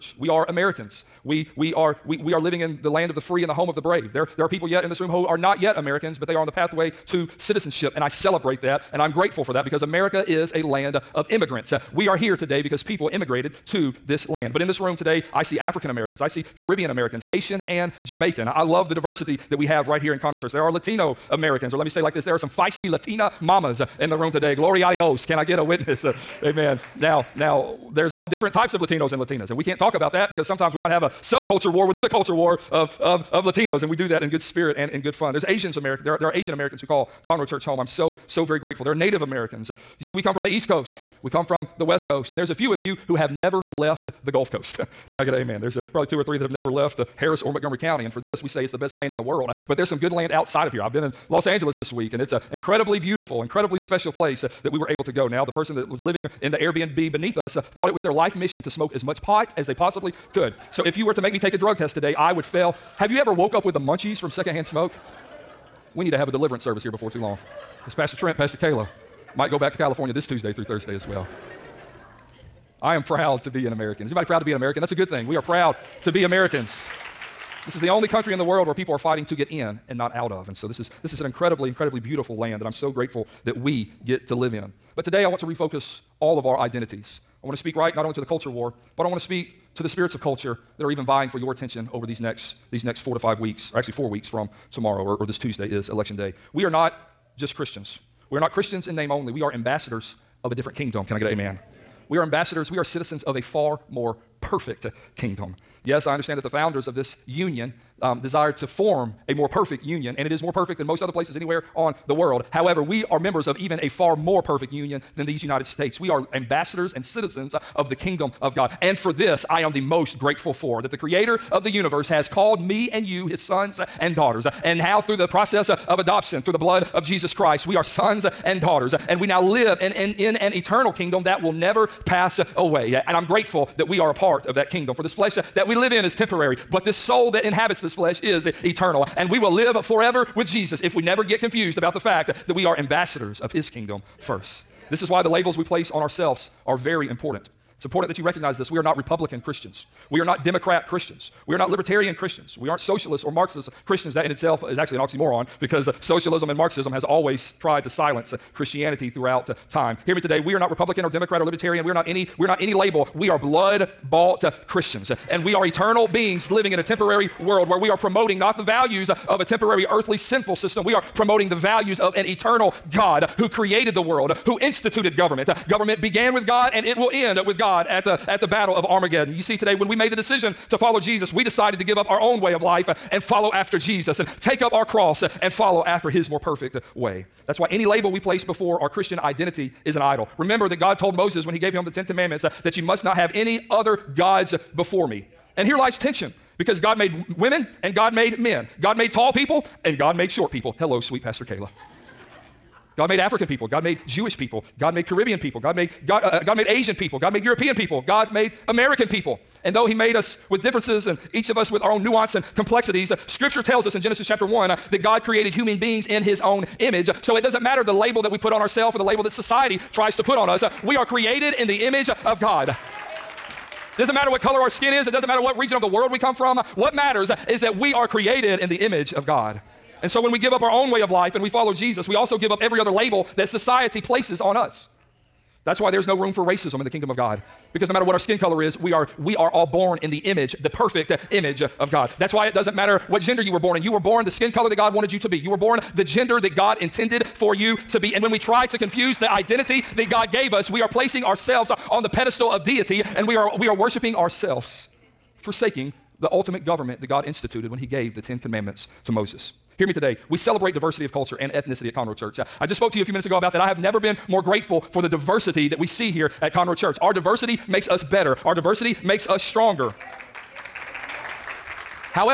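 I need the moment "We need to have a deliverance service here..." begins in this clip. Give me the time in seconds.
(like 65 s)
65 s.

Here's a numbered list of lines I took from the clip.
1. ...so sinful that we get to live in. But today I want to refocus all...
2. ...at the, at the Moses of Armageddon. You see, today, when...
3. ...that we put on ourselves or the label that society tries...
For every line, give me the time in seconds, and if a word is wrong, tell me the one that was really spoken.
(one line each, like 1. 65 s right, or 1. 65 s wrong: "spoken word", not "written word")
1. 82 s wrong: "grateful", not "sinful"
2. 177 s wrong: "Battle", not "Moses"
3. 218 s right.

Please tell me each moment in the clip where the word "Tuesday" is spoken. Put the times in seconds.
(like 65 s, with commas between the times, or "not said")
70 s, 95 s.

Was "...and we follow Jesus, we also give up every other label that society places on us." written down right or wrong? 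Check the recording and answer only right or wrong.
right.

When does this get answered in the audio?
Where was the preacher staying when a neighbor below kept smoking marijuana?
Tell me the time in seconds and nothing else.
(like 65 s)
56 s.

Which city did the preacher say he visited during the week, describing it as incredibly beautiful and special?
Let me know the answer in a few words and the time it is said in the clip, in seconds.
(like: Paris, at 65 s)
Los Angeles, at 51 s.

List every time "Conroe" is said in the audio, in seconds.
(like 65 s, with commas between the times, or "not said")
20 s, 37 s, 261 s, 266 s.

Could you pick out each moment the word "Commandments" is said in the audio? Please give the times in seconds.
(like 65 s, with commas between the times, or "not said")
192 s, 258 s.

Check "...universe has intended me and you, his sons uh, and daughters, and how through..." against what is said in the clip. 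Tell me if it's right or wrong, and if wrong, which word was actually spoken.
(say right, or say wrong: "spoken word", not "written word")
wrong: "called", not "intended".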